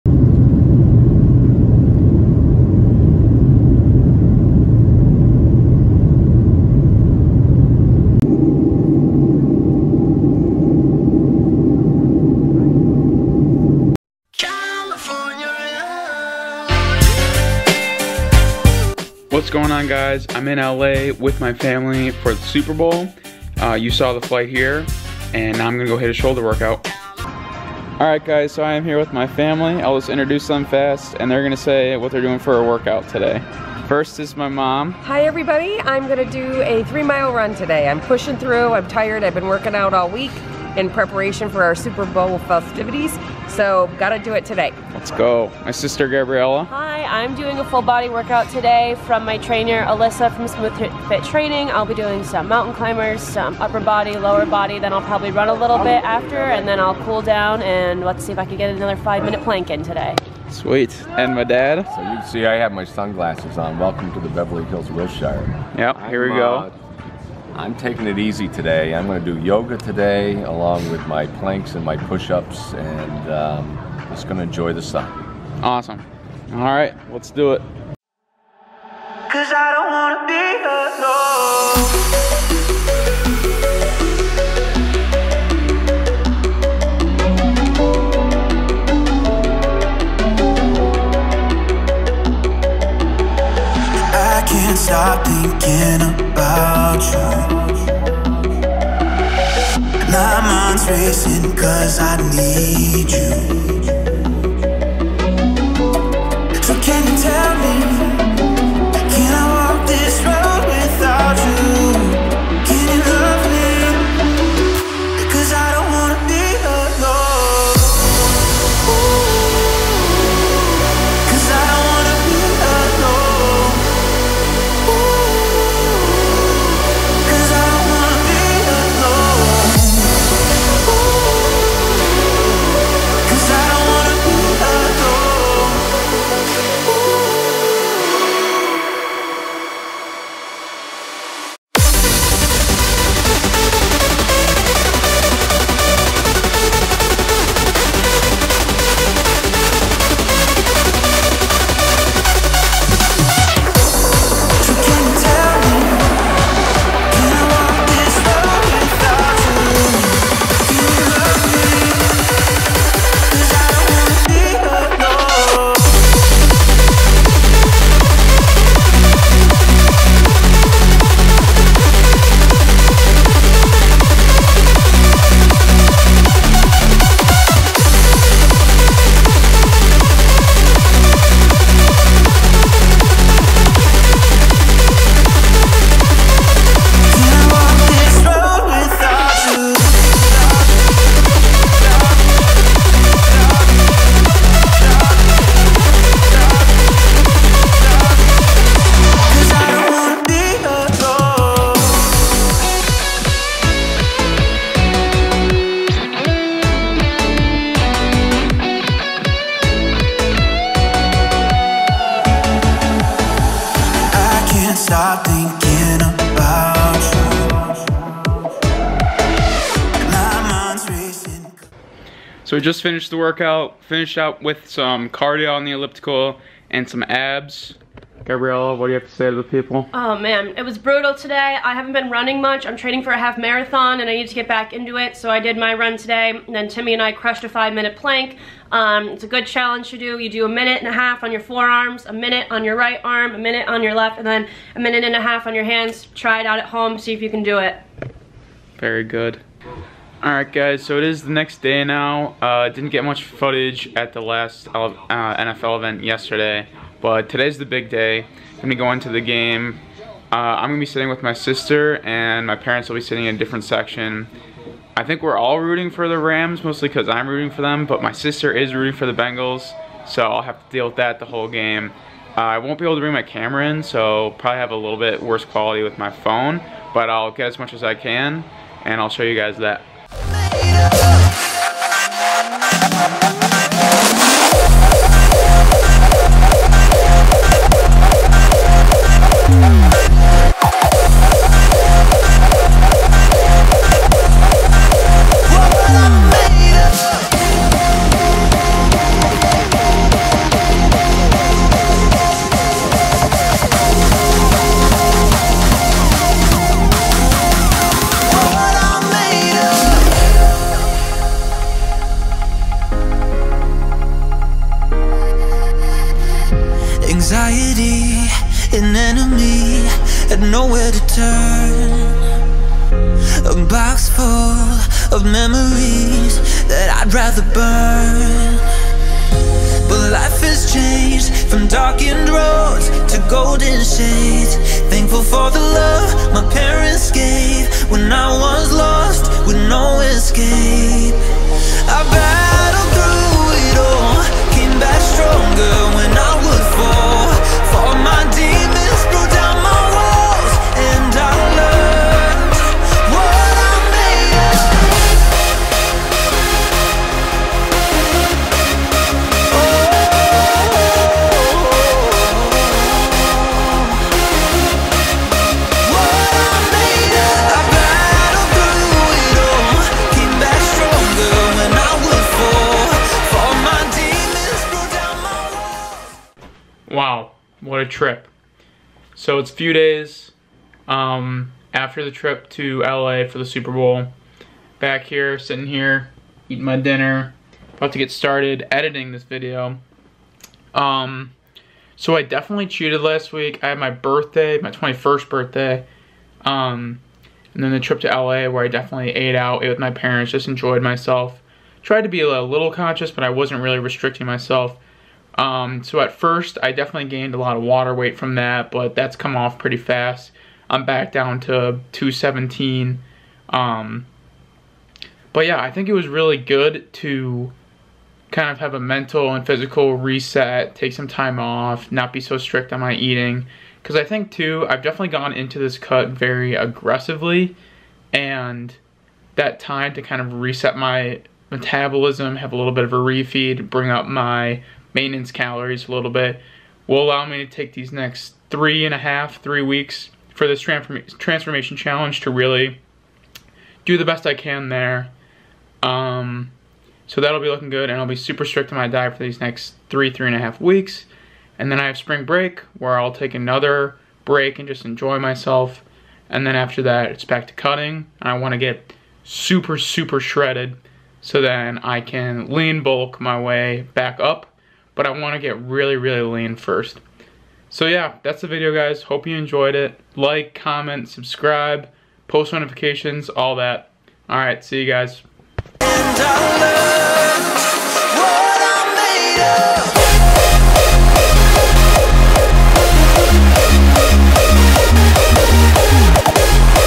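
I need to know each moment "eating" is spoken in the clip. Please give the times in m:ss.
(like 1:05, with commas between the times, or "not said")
6:26, 7:02.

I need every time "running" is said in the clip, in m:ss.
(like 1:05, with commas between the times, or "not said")
3:52.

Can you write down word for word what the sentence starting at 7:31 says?
And then I have spring break where I'll take another break and just enjoy myself.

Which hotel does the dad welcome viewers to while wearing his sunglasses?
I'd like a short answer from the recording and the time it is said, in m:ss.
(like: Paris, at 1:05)
Beverly Hills Wilshire, at 1:04.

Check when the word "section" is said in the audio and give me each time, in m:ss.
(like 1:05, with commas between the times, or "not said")
4:23.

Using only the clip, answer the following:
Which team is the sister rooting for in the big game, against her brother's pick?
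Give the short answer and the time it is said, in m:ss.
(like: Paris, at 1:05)
Bengals, at 4:29.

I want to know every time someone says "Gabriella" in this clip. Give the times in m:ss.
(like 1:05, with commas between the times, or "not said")
0:46, 3:48.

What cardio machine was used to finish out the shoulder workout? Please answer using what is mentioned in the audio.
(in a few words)
Elliptical.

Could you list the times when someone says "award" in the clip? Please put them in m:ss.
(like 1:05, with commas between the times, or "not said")
not said.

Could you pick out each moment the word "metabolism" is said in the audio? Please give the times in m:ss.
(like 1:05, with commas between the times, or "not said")
7:11.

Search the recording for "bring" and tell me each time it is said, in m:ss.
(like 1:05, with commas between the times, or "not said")
4:33, 7:13.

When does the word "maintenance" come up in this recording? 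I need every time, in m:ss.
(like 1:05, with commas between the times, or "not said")
7:14.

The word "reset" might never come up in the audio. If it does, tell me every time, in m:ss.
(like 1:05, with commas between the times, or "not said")
6:59, 7:10.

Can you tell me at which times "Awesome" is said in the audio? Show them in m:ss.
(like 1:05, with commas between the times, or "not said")
1:15.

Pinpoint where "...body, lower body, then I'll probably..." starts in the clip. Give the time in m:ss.
0:53.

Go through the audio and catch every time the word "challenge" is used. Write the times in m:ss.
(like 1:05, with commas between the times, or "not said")
3:59, 7:21.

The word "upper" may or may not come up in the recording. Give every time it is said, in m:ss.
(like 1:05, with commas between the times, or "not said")
0:53.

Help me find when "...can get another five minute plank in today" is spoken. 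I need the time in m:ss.
0:58.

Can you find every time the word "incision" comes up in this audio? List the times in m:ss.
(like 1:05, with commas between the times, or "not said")
not said.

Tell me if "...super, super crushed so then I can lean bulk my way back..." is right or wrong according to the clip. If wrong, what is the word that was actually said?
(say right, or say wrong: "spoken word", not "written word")
wrong: "shredded", not "crushed".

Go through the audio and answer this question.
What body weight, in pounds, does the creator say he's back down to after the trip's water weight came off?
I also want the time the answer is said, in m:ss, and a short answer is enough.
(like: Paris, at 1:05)
217, at 6:51.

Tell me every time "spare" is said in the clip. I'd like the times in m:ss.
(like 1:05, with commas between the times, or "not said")
not said.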